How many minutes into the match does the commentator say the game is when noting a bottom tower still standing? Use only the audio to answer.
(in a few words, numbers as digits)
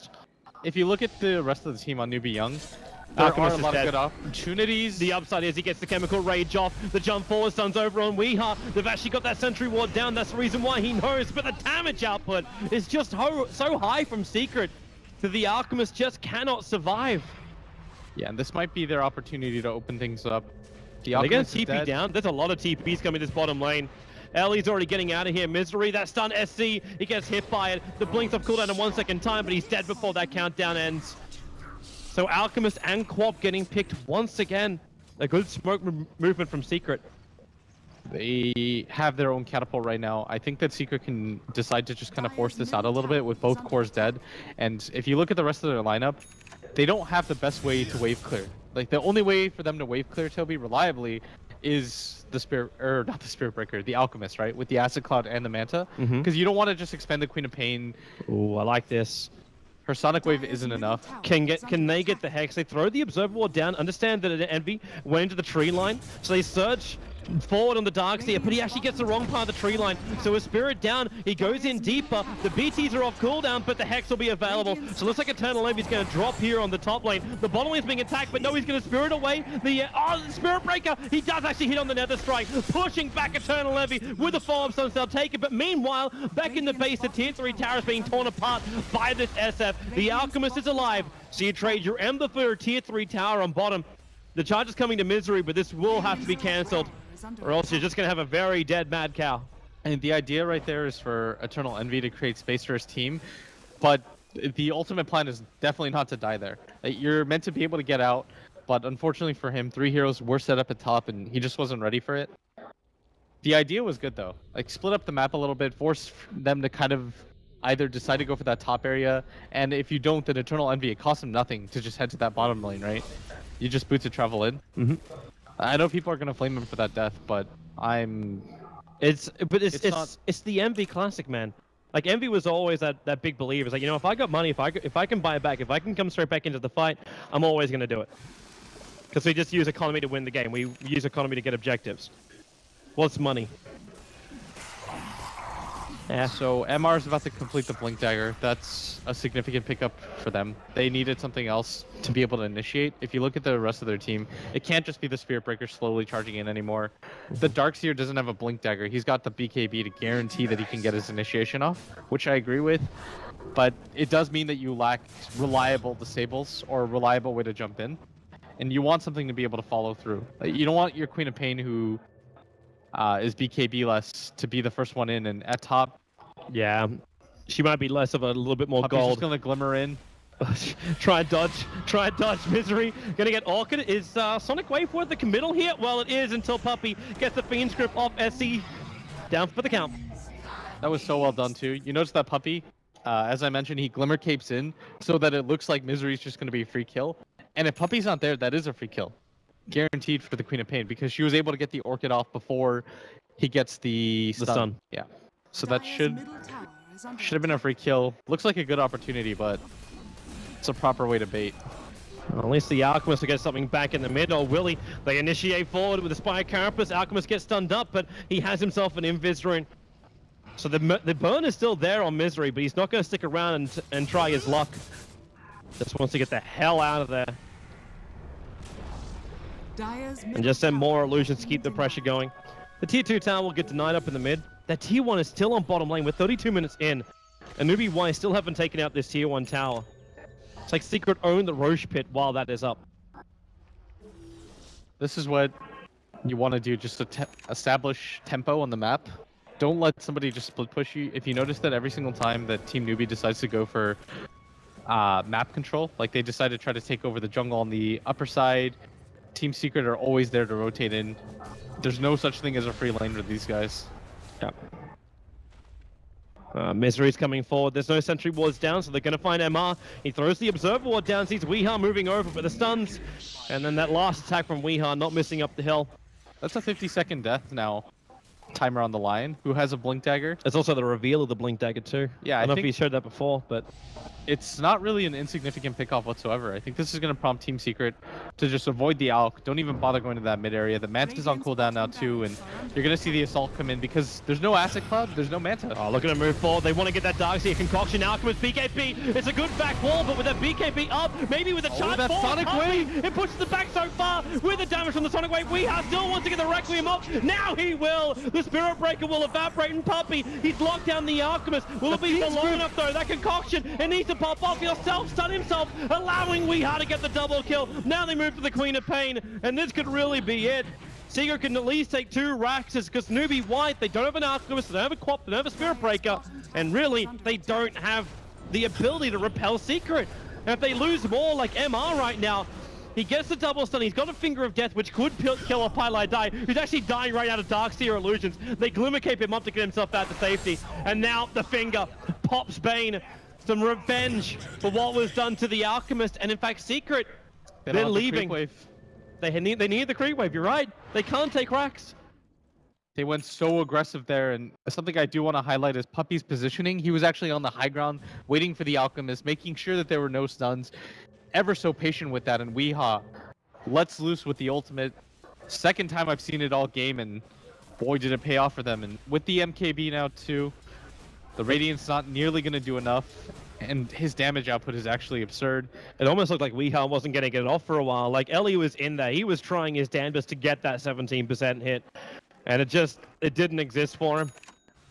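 32.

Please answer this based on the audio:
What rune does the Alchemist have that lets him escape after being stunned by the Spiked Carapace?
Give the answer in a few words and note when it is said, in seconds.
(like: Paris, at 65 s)
Invis rune, at 219 s.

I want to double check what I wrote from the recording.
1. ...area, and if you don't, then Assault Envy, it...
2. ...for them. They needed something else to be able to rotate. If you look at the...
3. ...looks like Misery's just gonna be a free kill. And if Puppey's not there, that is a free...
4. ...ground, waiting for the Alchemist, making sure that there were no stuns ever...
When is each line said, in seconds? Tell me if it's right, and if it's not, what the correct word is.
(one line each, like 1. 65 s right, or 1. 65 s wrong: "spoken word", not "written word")
1. 118 s wrong: "Eternal", not "Assault"
2. 150 s wrong: "initiate", not "rotate"
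3. 195 s right
4. 357 s right.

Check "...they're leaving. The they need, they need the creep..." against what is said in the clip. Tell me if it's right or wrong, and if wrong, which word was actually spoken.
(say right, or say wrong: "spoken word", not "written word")
right.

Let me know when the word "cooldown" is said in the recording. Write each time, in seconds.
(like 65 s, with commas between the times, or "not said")
28 s, 73 s, 291 s.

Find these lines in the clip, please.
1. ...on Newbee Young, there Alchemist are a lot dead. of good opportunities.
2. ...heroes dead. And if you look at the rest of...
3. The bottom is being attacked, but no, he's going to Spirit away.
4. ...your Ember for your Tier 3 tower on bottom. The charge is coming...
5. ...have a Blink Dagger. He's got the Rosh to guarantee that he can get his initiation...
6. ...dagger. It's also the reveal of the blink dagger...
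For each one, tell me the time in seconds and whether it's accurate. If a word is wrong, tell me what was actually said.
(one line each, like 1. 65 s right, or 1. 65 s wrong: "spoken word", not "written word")
1. 2 s right
2. 43 s wrong: "cores", not "heroes"
3. 77 s right
4. 91 s right
5. 158 s wrong: "BKB", not "Rosh"
6. 280 s right.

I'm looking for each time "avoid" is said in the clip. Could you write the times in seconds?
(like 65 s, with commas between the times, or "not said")
288 s.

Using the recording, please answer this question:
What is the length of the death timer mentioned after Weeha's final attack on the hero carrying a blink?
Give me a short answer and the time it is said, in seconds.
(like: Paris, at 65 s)
50 seconds, at 276 s.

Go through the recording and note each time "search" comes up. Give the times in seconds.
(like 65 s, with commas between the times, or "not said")
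66 s.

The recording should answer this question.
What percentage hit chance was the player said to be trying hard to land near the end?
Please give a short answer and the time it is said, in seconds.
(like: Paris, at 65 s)
17%, at 380 s.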